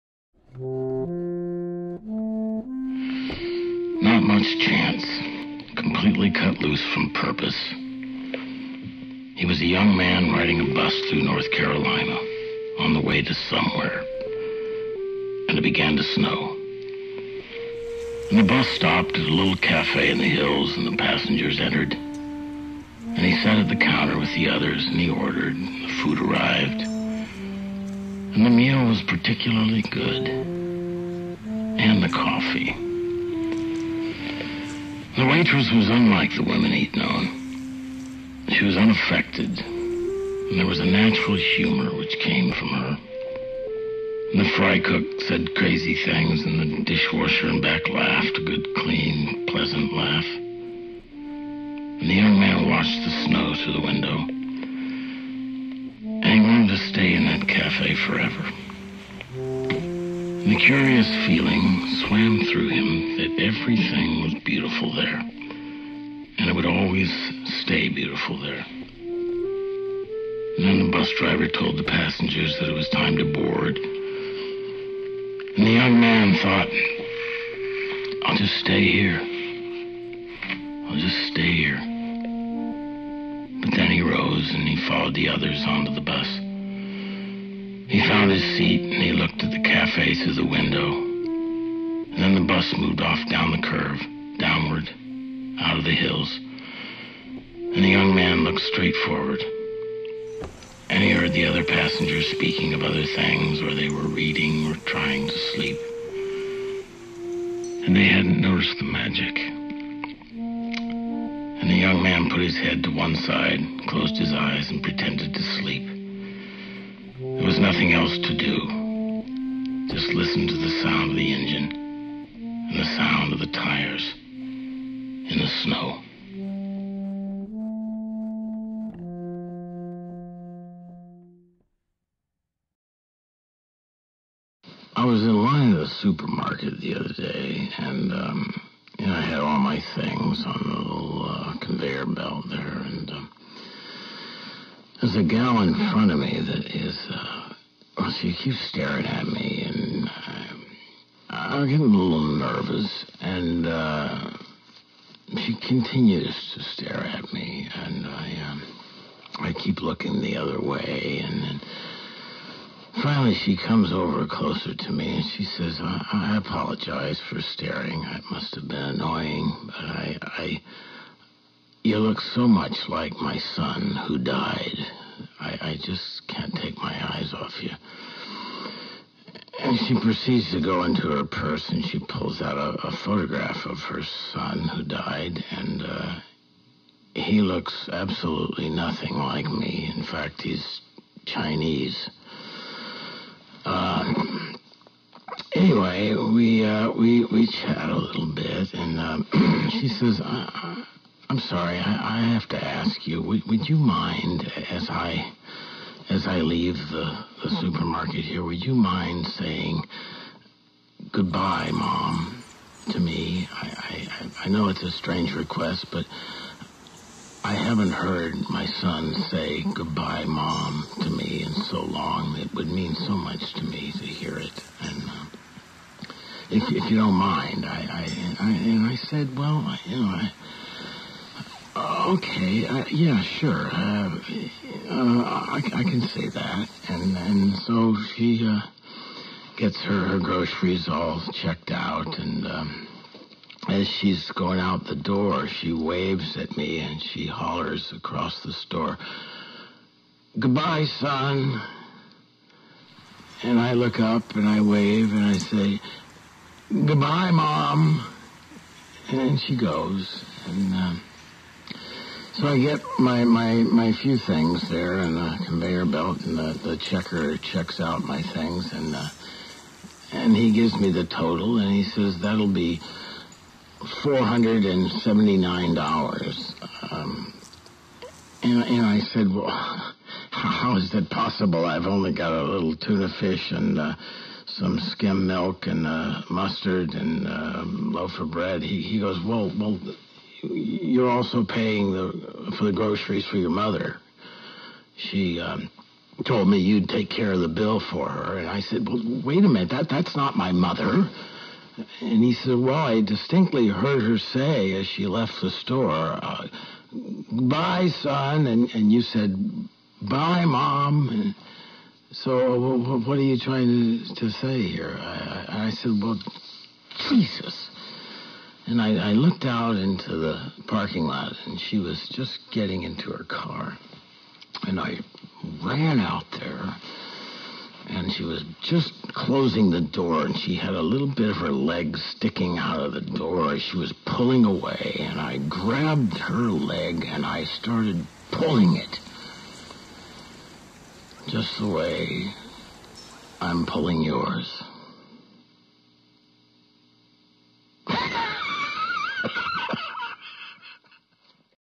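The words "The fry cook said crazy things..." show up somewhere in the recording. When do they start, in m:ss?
0:44.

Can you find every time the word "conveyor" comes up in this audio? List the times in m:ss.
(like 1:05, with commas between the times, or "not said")
2:21, 4:25.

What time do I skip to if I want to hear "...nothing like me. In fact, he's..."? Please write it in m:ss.
3:08.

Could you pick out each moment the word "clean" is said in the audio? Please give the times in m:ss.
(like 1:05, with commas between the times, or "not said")
0:48.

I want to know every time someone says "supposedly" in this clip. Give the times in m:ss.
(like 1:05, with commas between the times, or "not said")
not said.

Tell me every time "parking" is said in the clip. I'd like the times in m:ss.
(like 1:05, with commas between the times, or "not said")
5:20.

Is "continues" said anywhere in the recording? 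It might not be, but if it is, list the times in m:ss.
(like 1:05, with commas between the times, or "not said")
2:35.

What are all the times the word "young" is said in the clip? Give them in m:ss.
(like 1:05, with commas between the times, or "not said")
0:09, 0:52, 1:15, 1:37, 1:51.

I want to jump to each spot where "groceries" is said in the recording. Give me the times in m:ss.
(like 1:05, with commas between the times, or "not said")
4:00, 4:52.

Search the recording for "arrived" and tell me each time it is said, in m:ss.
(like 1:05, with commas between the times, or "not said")
0:26.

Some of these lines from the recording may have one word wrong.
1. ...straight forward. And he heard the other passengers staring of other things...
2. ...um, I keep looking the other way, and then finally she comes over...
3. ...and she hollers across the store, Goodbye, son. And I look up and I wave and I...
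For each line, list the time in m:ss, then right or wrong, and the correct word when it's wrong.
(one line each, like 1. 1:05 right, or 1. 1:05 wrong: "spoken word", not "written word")
1. 1:38 wrong: "speaking", not "staring"
2. 2:38 right
3. 4:06 right.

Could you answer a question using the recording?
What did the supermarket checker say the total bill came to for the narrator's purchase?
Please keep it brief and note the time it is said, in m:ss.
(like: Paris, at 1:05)
$479, at 4:34.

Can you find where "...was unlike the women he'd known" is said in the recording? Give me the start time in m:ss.
0:35.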